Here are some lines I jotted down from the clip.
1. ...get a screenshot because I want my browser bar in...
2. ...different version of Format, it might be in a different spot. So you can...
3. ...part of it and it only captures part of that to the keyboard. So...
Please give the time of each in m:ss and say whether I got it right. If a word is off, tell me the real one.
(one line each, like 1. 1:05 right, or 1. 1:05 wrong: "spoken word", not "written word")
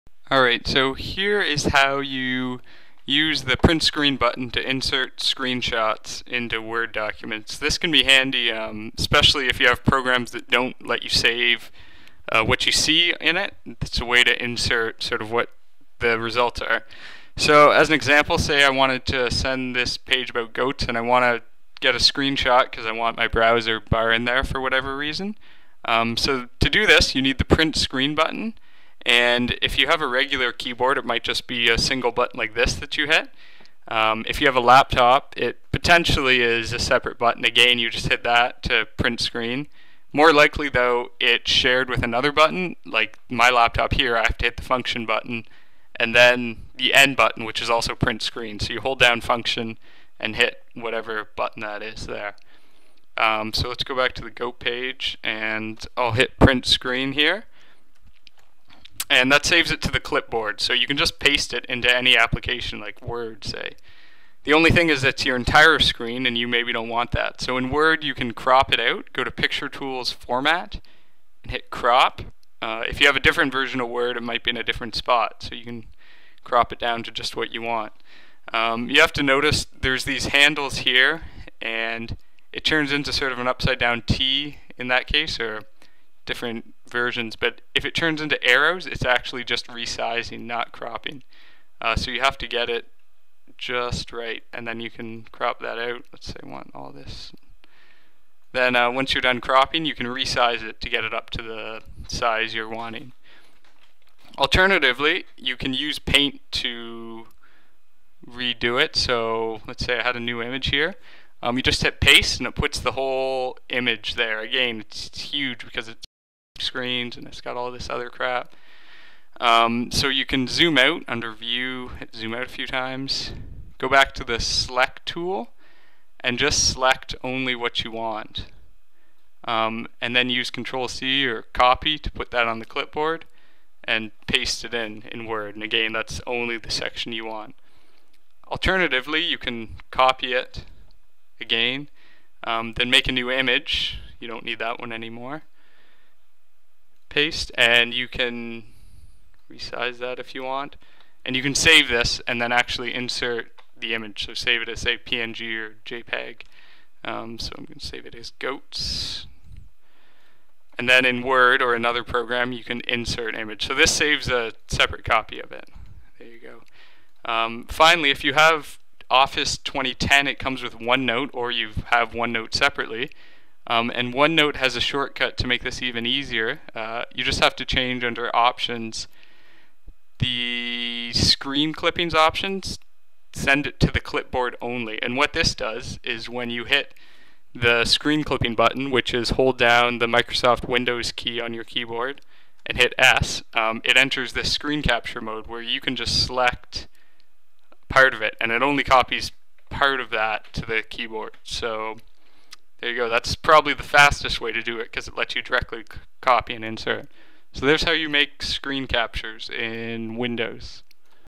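1. 0:21 right
2. 1:13 wrong: "Word", not "Format"
3. 3:17 wrong: "copies", not "captures".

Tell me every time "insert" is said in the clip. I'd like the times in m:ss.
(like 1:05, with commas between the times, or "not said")
0:04, 0:14, 2:32, 2:42, 3:26.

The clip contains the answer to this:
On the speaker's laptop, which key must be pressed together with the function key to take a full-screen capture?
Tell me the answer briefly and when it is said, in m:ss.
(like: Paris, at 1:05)
End, at 0:46.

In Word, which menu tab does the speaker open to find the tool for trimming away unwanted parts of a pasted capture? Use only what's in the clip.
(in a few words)
Picture Tools Format.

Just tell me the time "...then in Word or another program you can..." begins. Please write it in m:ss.
2:40.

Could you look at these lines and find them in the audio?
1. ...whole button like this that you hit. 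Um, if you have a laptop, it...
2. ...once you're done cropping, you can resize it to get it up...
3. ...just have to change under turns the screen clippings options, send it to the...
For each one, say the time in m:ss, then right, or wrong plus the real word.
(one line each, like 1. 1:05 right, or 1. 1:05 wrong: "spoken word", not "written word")
1. 0:31 wrong: "single", not "whole"
2. 1:38 right
3. 2:57 wrong: "options", not "turns".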